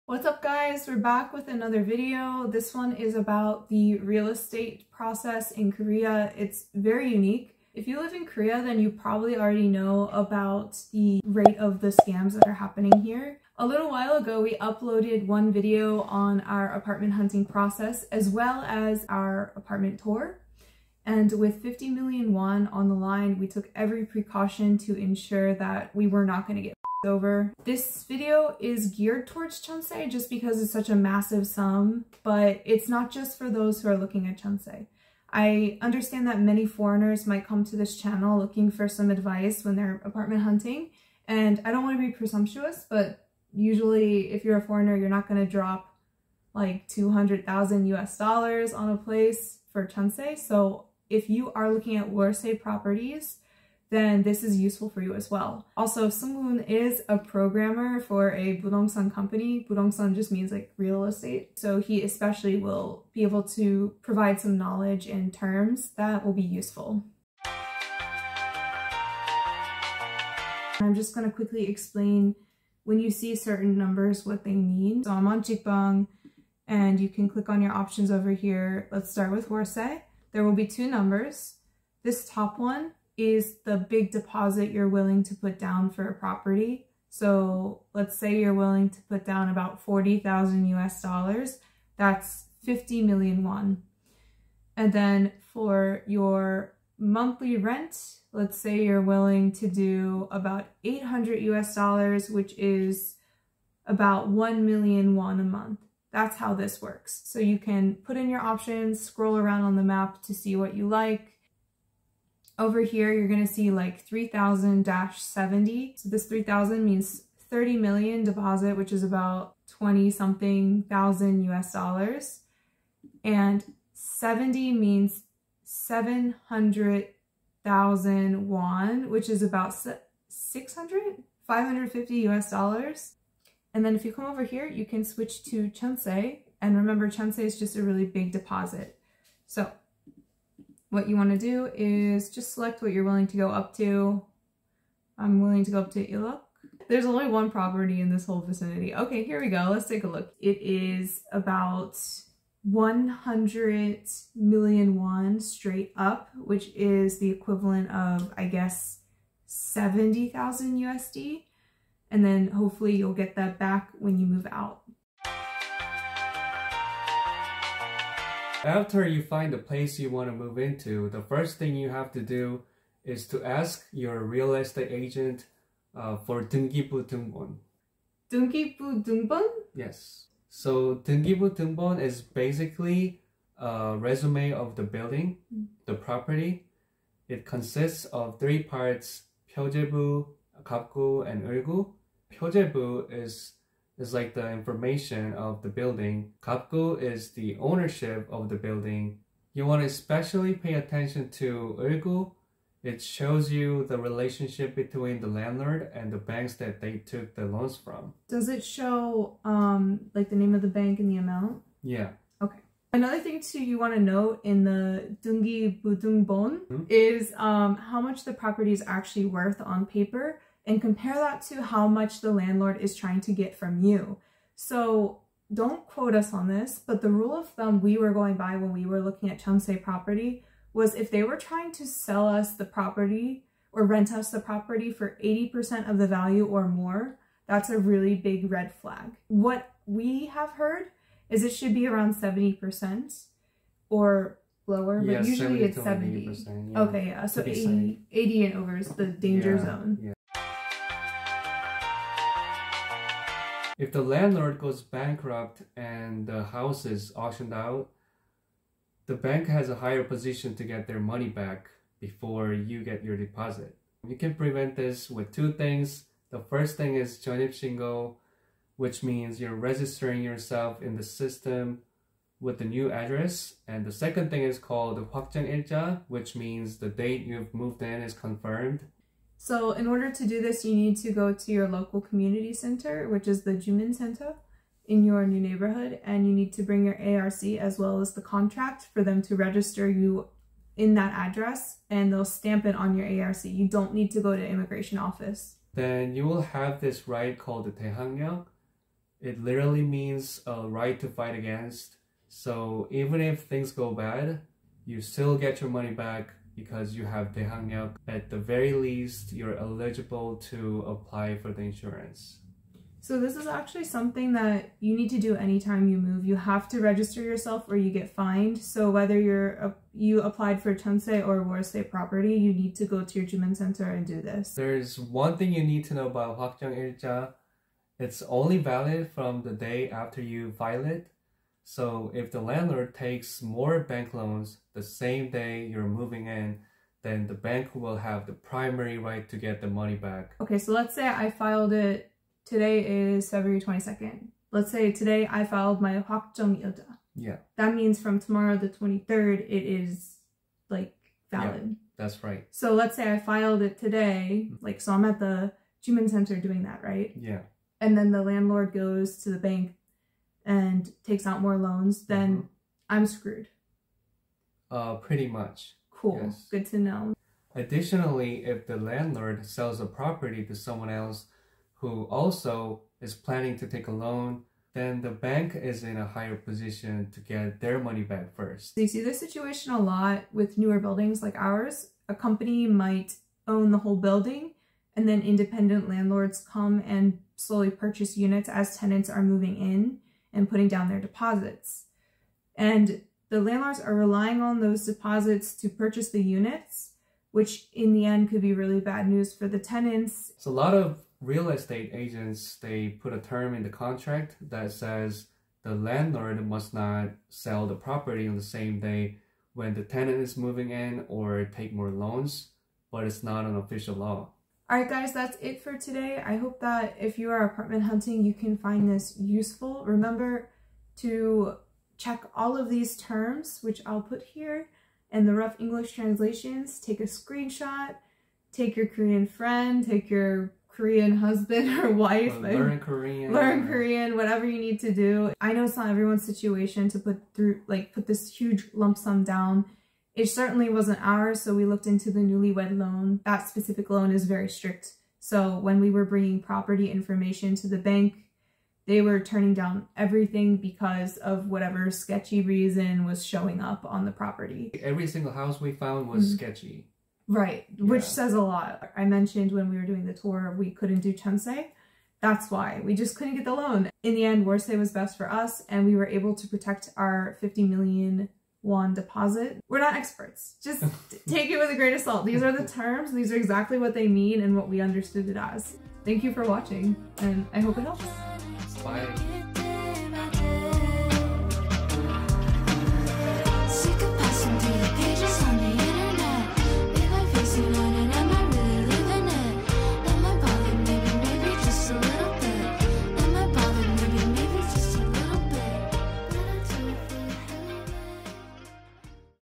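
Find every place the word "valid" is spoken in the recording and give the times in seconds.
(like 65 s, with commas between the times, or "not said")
328 s, 351 s.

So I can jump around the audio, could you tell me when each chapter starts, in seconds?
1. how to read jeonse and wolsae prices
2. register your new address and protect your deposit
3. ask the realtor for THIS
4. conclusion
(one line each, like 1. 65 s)
1. 67 s
2. 250 s
3. 165 s
4. 414 s.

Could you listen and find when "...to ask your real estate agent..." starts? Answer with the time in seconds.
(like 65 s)
173 s.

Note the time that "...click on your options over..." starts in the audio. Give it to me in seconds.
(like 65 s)
77 s.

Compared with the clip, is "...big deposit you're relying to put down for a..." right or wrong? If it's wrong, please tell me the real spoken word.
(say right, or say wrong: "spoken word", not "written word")
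wrong: "willing", not "relying".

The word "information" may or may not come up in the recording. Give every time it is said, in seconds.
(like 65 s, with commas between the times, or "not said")
194 s, 446 s.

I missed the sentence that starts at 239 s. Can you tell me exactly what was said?
What we have heard is it should be around 70% or lower, but usually 70 it's 70.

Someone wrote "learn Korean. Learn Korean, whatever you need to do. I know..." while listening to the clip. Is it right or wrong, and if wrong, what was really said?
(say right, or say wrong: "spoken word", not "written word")
right.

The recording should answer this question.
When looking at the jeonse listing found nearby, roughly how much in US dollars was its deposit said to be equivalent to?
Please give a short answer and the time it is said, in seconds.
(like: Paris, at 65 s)
70,000 USD, at 159 s.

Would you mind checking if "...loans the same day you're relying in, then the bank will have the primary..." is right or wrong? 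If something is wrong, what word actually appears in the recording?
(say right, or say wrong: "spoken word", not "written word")
wrong: "moving", not "relying".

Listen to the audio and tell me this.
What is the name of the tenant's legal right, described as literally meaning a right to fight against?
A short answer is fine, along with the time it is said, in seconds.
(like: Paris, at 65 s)
Taehangyang, at 297 s.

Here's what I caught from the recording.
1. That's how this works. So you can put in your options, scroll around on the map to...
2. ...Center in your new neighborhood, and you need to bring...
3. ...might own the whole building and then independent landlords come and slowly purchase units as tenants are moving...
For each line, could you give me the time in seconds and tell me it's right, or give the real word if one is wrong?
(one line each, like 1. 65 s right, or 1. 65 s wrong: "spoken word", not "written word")
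1. 106 s right
2. 283 s right
3. 382 s right.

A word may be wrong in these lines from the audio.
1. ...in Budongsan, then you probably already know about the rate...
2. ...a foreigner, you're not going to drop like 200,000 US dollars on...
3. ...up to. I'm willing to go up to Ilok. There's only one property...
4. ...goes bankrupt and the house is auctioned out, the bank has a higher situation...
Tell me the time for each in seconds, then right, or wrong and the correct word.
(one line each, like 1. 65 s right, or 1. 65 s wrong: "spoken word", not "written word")
1. 8 s wrong: "Korea", not "Budongsan"
2. 44 s right
3. 143 s right
4. 254 s wrong: "position", not "situation".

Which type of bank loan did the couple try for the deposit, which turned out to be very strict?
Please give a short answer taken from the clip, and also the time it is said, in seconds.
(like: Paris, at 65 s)
newlywed loan, at 442 s.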